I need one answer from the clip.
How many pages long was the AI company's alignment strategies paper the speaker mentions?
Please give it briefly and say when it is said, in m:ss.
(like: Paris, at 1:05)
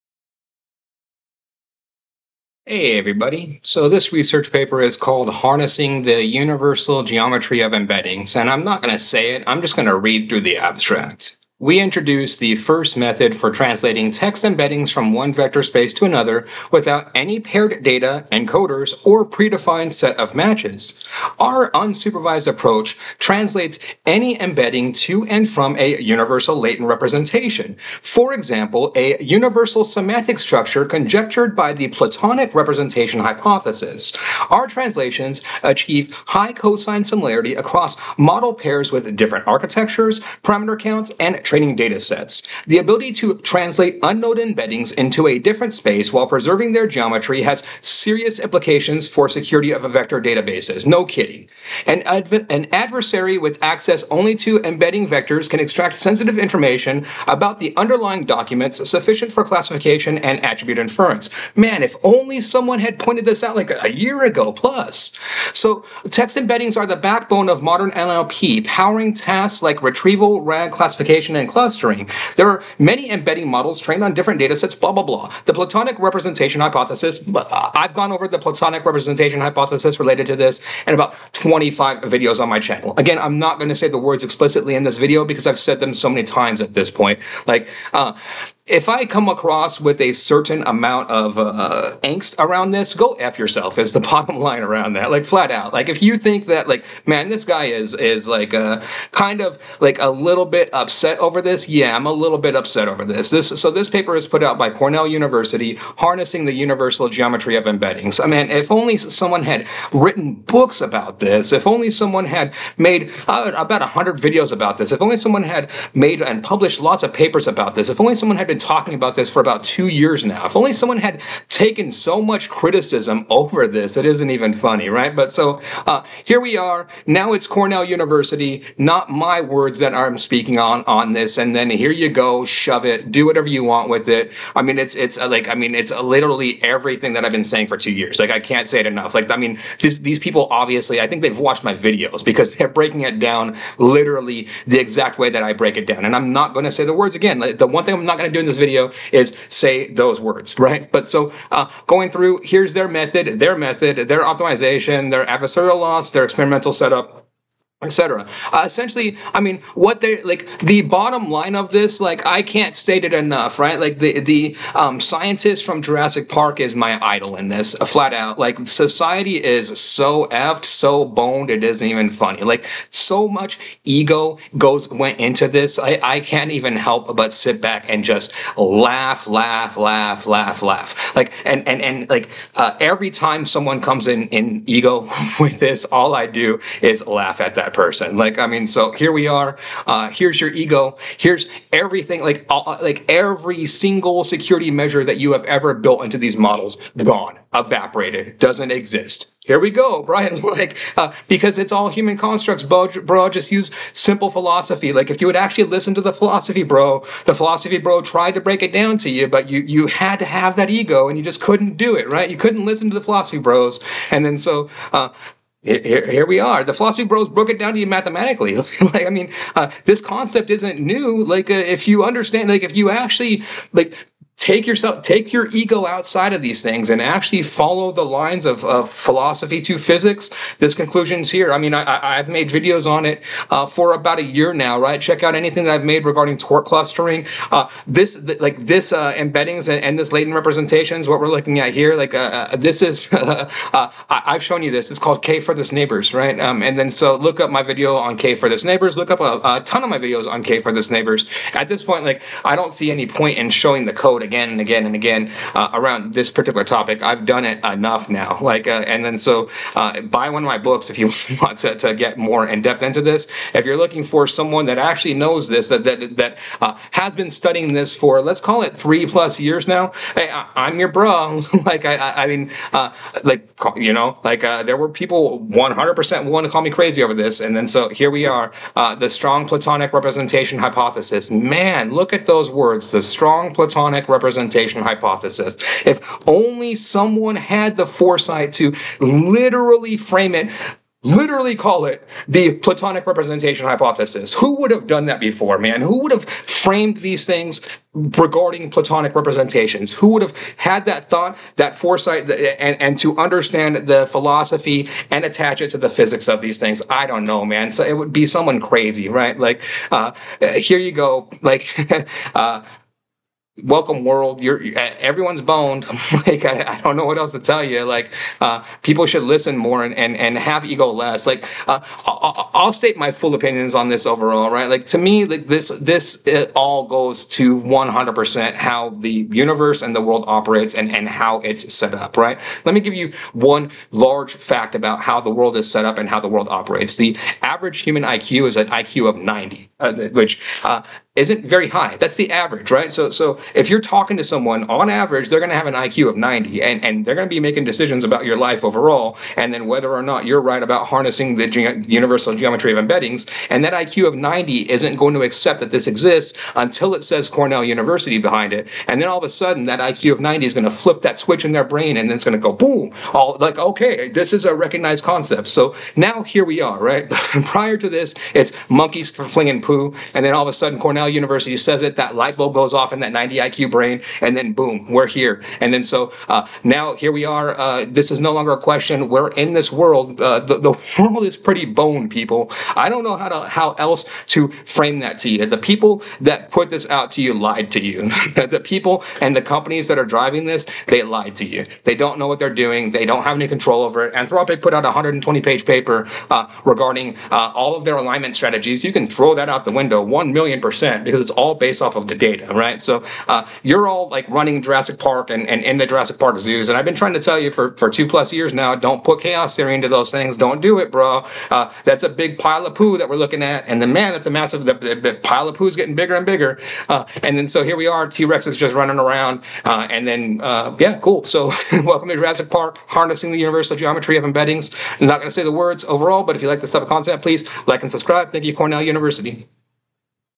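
120, at 6:34.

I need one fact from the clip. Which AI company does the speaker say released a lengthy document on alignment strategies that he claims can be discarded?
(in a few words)
Anthropic.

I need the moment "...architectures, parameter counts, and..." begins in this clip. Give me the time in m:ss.
0:39.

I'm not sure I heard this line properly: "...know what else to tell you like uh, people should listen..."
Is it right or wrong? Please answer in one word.
right.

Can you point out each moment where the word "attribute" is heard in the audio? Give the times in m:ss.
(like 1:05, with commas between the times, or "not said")
1:00.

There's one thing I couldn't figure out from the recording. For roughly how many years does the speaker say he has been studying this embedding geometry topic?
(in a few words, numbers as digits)
3.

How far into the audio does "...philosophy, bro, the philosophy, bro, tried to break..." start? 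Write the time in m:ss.
3:26.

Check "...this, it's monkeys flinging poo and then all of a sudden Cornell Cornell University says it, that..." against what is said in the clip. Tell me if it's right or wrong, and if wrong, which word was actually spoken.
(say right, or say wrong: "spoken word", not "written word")
right.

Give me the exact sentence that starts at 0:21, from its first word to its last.
Our unsupervised approach translates any embedding to and from a universal latent representation.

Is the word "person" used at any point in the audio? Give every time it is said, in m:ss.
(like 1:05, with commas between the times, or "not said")
3:07.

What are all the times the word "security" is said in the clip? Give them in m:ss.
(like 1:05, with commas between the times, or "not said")
0:49, 3:14.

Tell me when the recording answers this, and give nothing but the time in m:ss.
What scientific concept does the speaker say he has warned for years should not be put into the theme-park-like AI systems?
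6:49.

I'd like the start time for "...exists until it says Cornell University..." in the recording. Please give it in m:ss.
5:55.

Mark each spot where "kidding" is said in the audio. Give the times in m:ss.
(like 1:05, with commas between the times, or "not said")
0:51.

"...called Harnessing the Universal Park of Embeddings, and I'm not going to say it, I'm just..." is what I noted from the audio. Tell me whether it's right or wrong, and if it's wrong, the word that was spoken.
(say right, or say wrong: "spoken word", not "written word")
wrong: "Geometry", not "Park".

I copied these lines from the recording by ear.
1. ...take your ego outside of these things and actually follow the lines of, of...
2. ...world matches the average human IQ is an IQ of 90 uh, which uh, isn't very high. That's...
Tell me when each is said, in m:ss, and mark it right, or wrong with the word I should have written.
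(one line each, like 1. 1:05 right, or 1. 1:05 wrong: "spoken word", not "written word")
1. 3:45 right
2. 5:36 wrong: "operates", not "matches".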